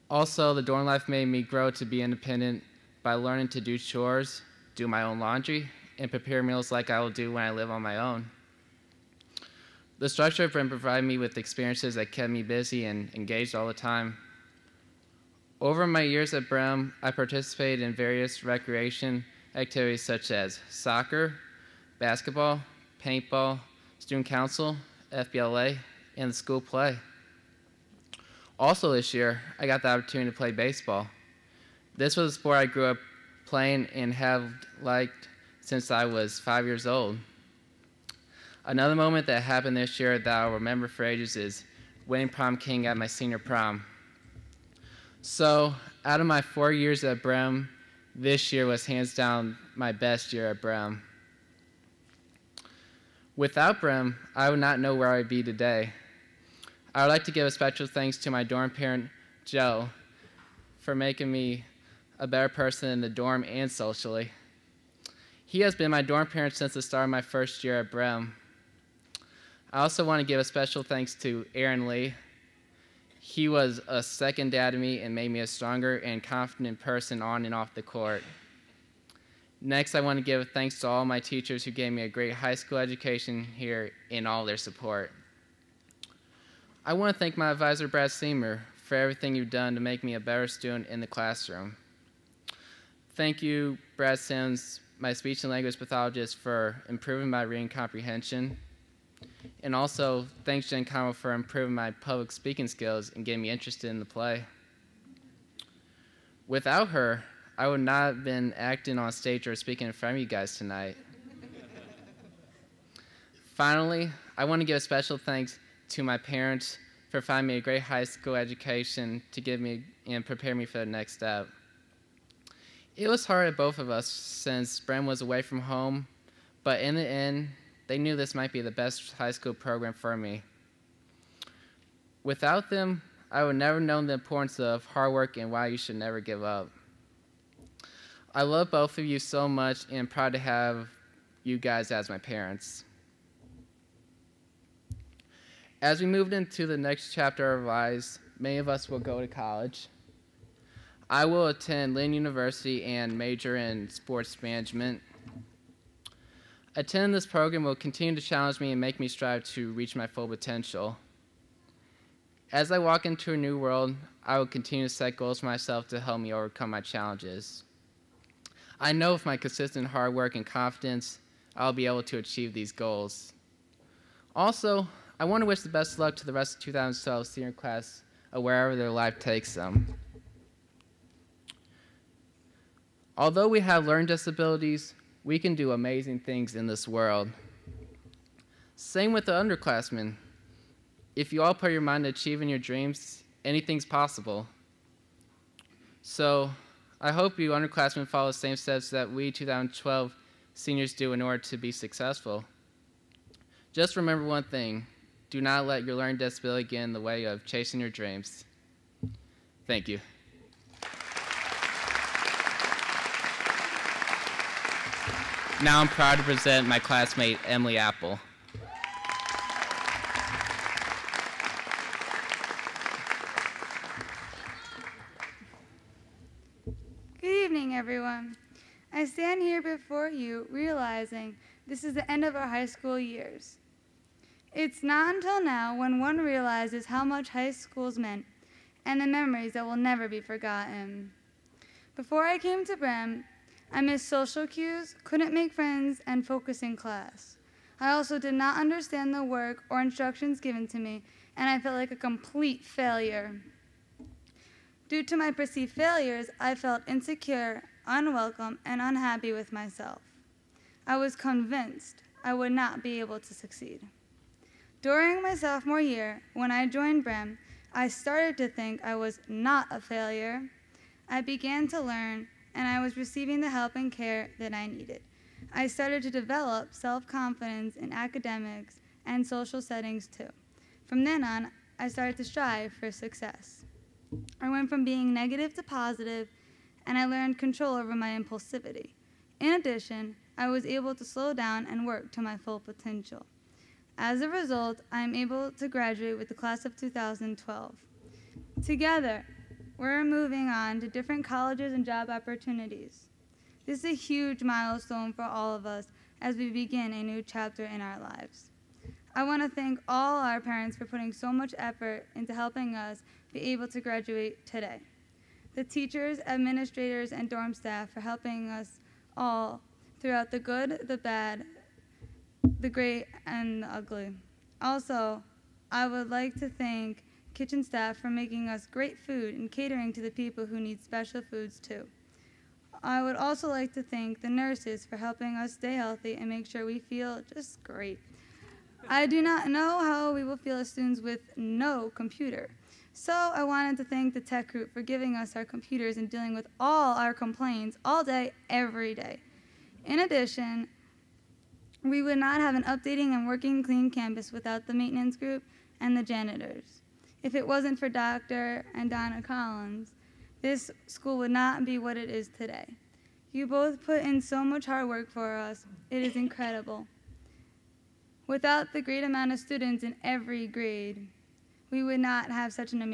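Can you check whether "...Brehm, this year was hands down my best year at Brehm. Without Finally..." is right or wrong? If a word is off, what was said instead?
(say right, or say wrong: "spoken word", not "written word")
wrong: "Brehm", not "Finally".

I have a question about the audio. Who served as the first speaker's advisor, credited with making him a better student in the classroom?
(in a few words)
Brad Seymour.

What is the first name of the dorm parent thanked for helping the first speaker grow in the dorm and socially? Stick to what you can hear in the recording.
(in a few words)
Joe.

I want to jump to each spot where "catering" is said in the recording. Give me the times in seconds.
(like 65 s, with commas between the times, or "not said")
329 s.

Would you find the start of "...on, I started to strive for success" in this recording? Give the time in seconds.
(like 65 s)
281 s.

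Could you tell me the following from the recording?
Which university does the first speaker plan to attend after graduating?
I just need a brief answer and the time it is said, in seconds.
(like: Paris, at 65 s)
Lynn University, at 151 s.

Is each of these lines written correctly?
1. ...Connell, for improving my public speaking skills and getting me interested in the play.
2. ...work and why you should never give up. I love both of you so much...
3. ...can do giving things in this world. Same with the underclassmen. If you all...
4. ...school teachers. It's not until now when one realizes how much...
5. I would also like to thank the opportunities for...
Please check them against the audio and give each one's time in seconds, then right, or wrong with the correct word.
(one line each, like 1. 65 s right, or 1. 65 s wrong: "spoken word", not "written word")
1. 100 s right
2. 135 s right
3. 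185 s wrong: "amazing", not "giving"
4. 232 s wrong: "years", not "teachers"
5. 332 s wrong: "nurses", not "opportunities".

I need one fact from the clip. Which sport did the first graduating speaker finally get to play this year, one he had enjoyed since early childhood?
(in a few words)
Baseball.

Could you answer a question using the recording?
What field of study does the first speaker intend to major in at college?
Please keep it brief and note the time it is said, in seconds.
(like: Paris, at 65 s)
Sports management, at 153 s.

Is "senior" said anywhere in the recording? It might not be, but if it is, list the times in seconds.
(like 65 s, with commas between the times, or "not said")
43 s, 177 s, 200 s.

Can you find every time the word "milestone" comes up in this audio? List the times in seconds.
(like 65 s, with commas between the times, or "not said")
304 s.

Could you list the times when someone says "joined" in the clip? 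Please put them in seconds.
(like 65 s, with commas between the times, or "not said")
266 s.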